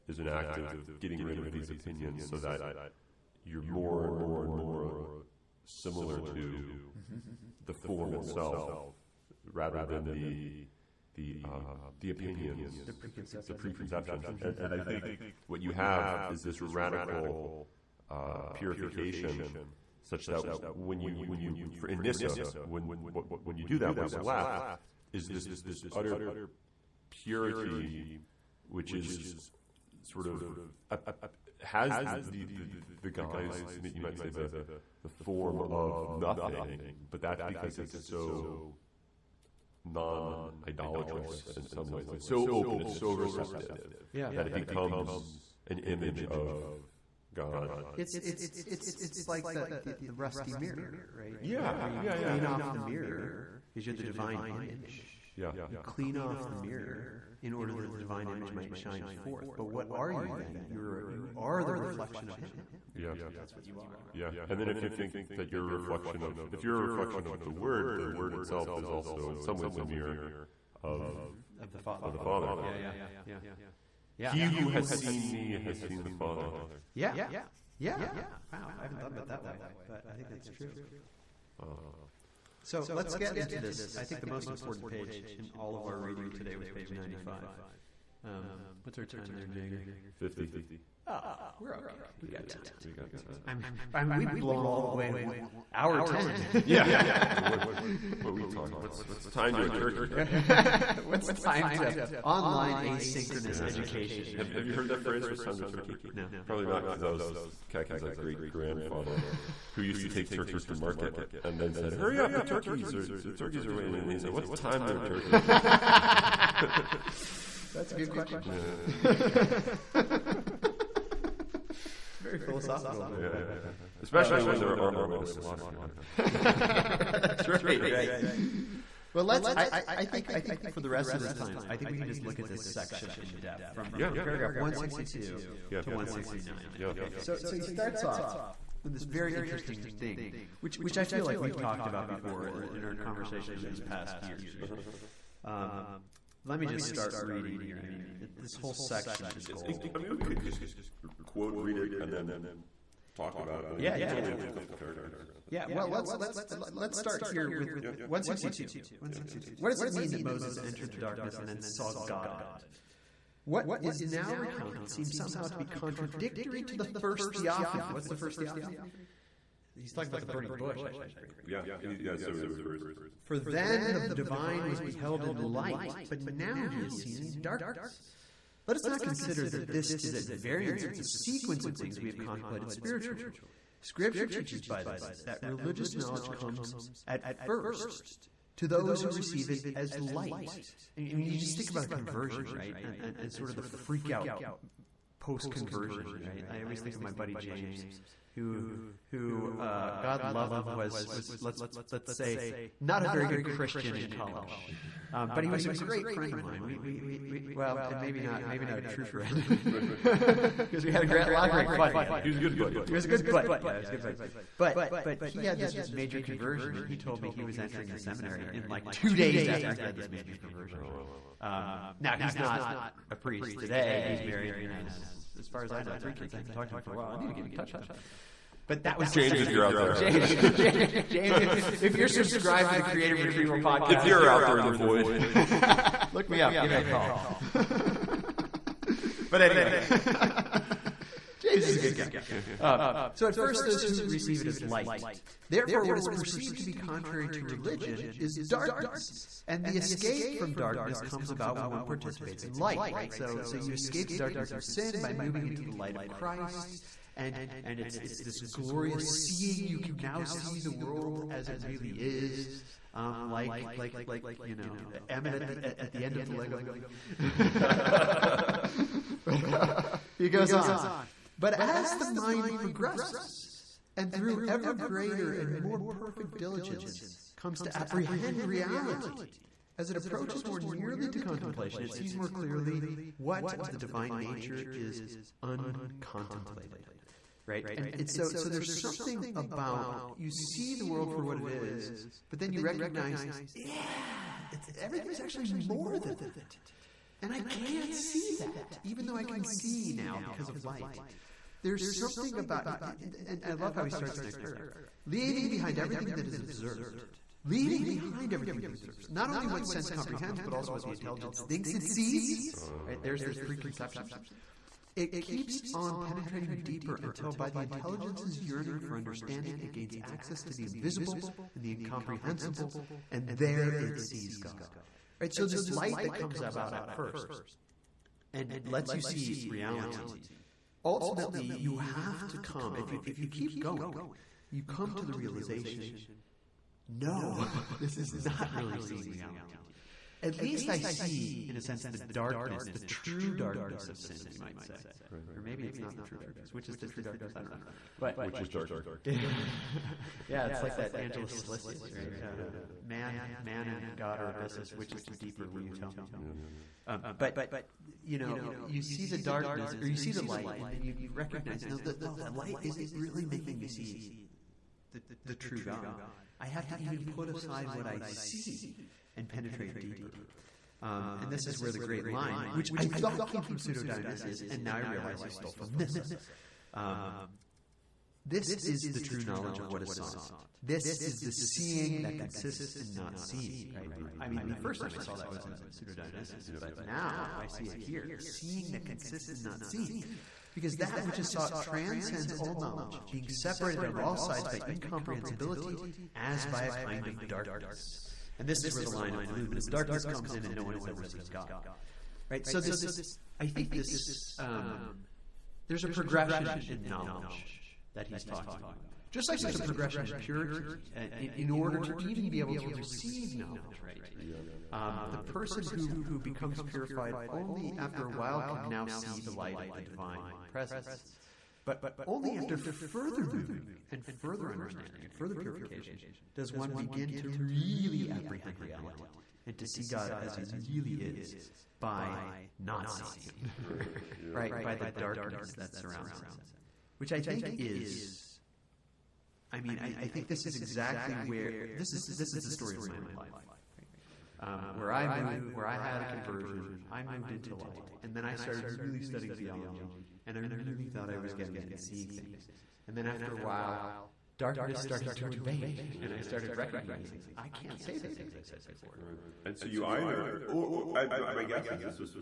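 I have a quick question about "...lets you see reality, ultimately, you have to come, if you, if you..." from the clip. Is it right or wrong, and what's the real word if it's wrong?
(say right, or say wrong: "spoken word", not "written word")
right.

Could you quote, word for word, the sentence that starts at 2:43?
What is now recounted seems somehow to be contradictory to the first theophany.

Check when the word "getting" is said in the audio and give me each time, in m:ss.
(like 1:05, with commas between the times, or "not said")
0:00, 7:31.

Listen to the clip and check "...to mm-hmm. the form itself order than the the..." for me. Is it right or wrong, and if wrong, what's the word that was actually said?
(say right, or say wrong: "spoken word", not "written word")
wrong: "rather", not "order".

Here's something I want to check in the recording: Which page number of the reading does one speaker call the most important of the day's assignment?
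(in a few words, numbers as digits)
95.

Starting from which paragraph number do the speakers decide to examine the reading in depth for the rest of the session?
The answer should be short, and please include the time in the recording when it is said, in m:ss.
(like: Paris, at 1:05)
162, at 2:14.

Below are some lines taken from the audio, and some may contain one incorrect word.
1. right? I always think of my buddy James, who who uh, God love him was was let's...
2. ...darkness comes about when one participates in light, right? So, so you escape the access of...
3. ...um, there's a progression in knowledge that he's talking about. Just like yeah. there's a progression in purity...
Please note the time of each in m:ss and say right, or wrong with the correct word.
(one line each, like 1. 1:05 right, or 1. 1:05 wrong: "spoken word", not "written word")
1. 3:16 right
2. 4:10 wrong: "darkness", not "access"
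3. 6:44 right.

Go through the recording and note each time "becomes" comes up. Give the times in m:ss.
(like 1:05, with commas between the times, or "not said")
0:44, 6:56.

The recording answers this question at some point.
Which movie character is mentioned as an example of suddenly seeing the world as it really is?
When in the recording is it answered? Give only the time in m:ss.
4:25.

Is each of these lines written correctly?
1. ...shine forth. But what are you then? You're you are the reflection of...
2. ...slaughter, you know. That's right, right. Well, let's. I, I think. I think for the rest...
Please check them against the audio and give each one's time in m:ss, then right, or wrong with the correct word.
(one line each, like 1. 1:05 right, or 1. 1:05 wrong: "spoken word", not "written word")
1. 0:58 right
2. 2:05 right.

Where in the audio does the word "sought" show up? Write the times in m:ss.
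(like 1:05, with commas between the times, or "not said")
6:19, 6:31.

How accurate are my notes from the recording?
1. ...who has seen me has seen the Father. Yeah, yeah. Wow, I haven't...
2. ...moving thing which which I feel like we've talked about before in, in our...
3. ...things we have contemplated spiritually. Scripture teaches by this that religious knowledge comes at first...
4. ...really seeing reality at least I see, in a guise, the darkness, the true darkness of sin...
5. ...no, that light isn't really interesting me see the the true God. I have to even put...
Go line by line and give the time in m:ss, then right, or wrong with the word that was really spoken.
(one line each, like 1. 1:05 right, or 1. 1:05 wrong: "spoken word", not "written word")
1. 1:14 right
2. 2:19 wrong: "interesting", not "moving"
3. 3:01 right
4. 5:38 wrong: "sense", not "guise"
5. 6:02 wrong: "making", not "interesting".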